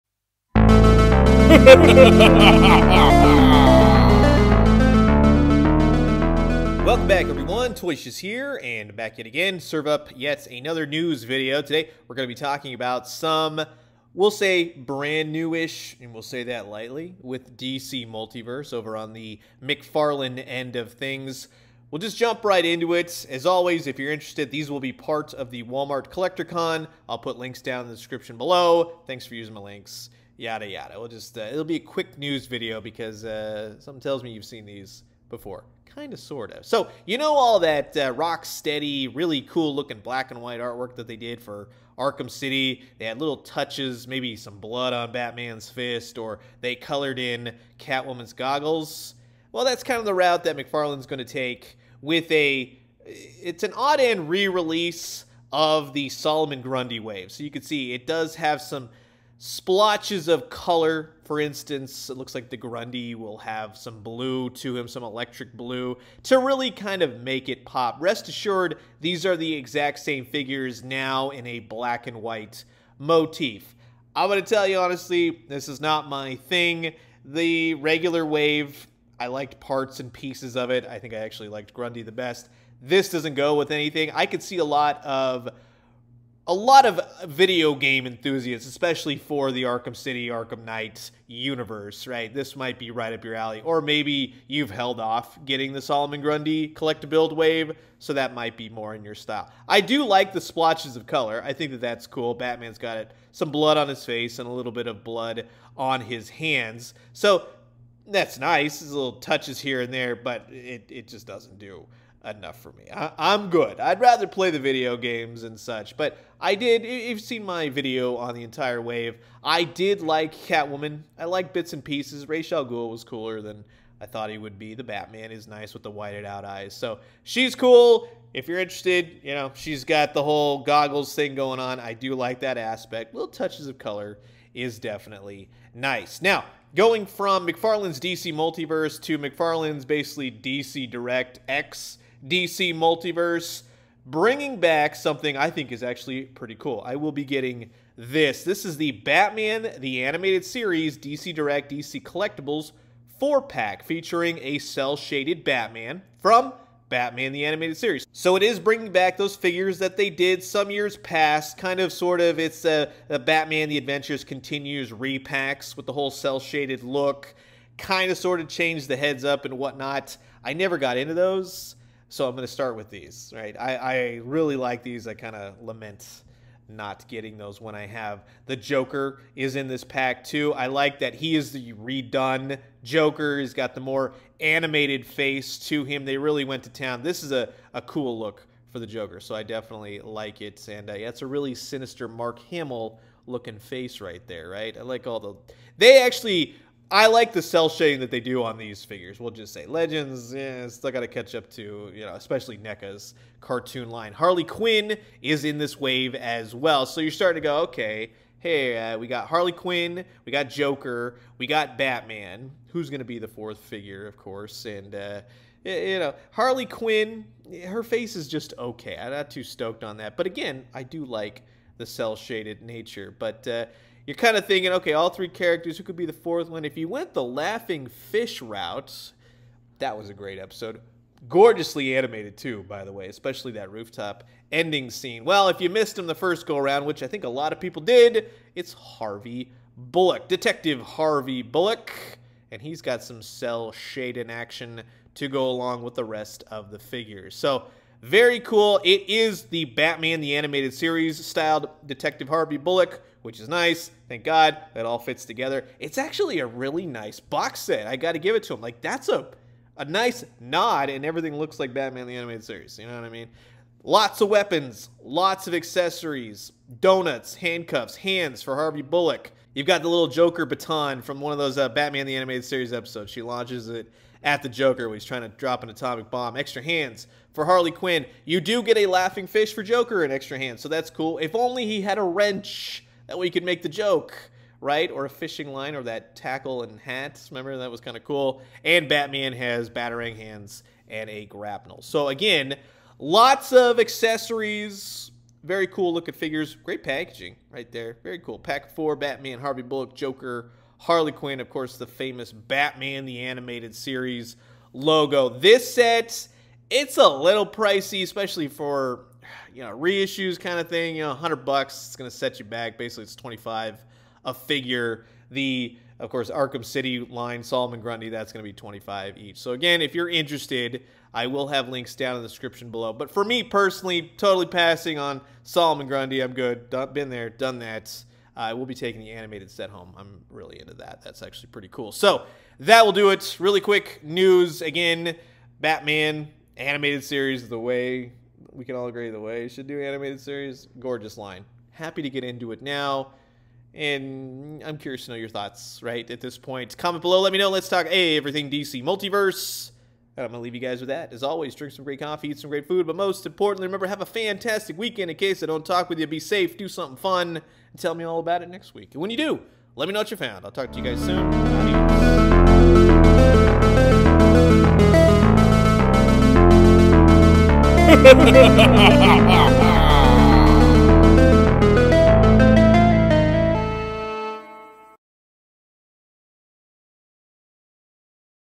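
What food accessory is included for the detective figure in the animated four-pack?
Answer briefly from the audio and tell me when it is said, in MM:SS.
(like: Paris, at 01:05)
donuts, at 04:26.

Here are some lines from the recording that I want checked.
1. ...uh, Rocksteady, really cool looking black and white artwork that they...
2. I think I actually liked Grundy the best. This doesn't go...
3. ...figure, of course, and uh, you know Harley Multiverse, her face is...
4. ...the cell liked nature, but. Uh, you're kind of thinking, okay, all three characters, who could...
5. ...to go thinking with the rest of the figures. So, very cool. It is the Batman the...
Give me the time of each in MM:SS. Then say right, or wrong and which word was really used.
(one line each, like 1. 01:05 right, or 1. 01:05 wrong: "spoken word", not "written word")
1. 00:37 right
2. 01:20 right
3. 03:33 wrong: "Quinn", not "Multiverse"
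4. 03:41 wrong: "shaded", not "liked"
5. 04:05 wrong: "along", not "thinking".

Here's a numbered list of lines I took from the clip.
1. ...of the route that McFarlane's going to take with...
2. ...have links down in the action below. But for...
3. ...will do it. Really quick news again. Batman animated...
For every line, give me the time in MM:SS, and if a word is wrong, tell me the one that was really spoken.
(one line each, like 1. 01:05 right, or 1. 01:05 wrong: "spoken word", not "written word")
1. 00:49 right
2. 05:21 wrong: "description", not "action"
3. 05:32 right.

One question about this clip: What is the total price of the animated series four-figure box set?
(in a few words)
$100.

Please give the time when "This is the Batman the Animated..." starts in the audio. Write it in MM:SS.
02:28.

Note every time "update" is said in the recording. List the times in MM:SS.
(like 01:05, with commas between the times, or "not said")
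not said.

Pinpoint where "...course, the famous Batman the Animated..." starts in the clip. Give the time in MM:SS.
05:01.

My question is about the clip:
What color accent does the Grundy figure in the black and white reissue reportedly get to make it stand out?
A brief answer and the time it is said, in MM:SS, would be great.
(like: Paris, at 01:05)
electric blue, at 01:05.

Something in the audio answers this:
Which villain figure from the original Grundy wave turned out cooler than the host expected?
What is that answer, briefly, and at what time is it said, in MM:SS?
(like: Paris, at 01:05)
Ras Al Ghul, at 02:02.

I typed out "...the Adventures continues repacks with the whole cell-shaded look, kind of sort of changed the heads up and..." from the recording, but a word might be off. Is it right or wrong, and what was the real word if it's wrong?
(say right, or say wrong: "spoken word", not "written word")
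right.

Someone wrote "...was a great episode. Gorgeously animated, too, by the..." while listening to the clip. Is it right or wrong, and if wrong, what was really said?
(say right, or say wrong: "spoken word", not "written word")
right.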